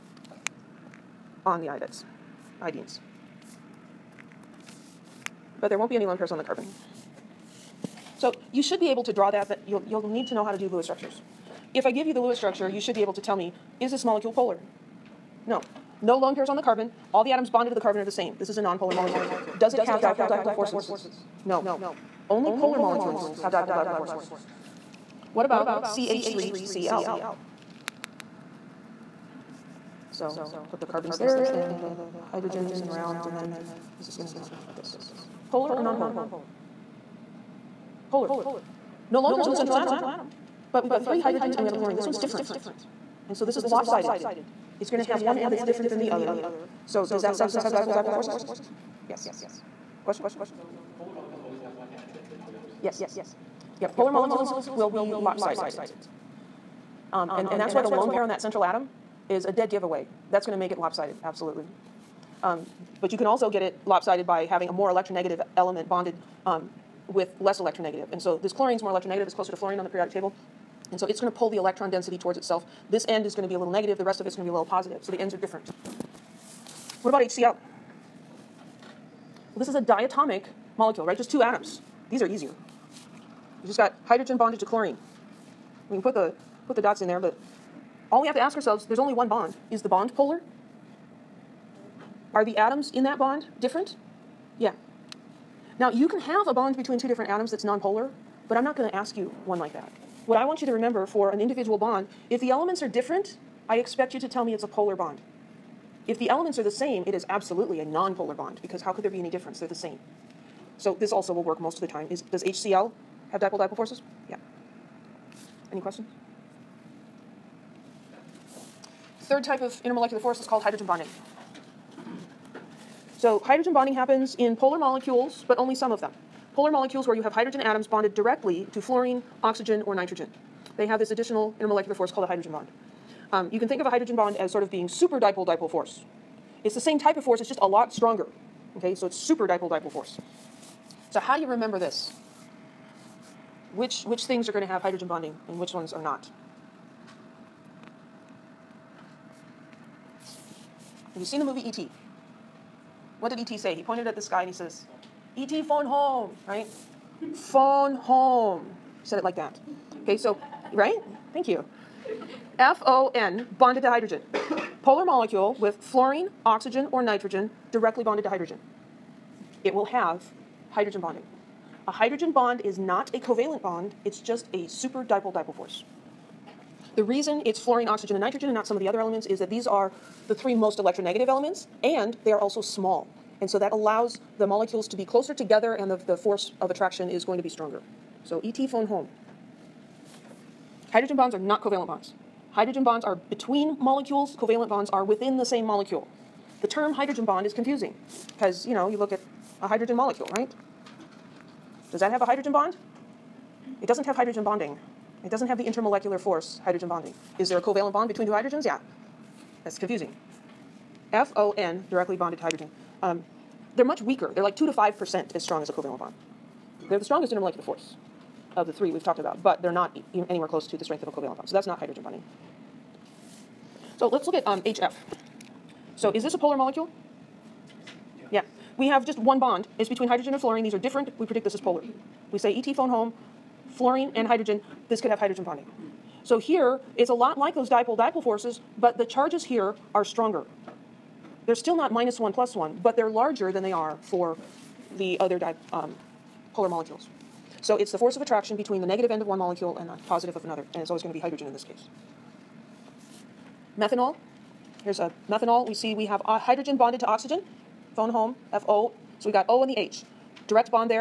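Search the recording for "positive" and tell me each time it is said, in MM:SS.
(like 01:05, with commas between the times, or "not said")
01:14, 04:10.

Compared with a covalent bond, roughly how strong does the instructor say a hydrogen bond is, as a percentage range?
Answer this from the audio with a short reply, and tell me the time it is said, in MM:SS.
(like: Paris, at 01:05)
2 to 5%, at 03:34.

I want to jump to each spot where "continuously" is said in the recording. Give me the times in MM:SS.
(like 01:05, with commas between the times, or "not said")
not said.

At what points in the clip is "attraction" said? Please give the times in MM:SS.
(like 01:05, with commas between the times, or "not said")
03:06, 04:08.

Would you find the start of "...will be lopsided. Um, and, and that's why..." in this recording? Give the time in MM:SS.
00:54.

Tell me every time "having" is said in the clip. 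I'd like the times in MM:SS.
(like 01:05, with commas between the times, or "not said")
01:04.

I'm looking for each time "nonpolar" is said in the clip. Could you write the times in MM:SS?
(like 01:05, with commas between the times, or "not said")
00:18, 00:35, 01:37, 01:47.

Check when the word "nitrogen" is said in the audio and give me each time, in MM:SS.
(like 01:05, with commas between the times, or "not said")
02:09, 02:47, 02:58.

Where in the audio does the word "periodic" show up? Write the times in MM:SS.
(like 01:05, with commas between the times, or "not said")
01:09.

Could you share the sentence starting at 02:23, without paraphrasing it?
which which things are going to have hydrogen bonding and which ones are not.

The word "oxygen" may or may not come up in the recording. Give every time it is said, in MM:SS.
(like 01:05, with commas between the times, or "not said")
02:09, 02:46, 02:57, 04:17.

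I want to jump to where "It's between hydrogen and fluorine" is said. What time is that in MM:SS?
03:49.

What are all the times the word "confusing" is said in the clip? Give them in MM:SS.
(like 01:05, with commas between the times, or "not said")
03:17, 03:29.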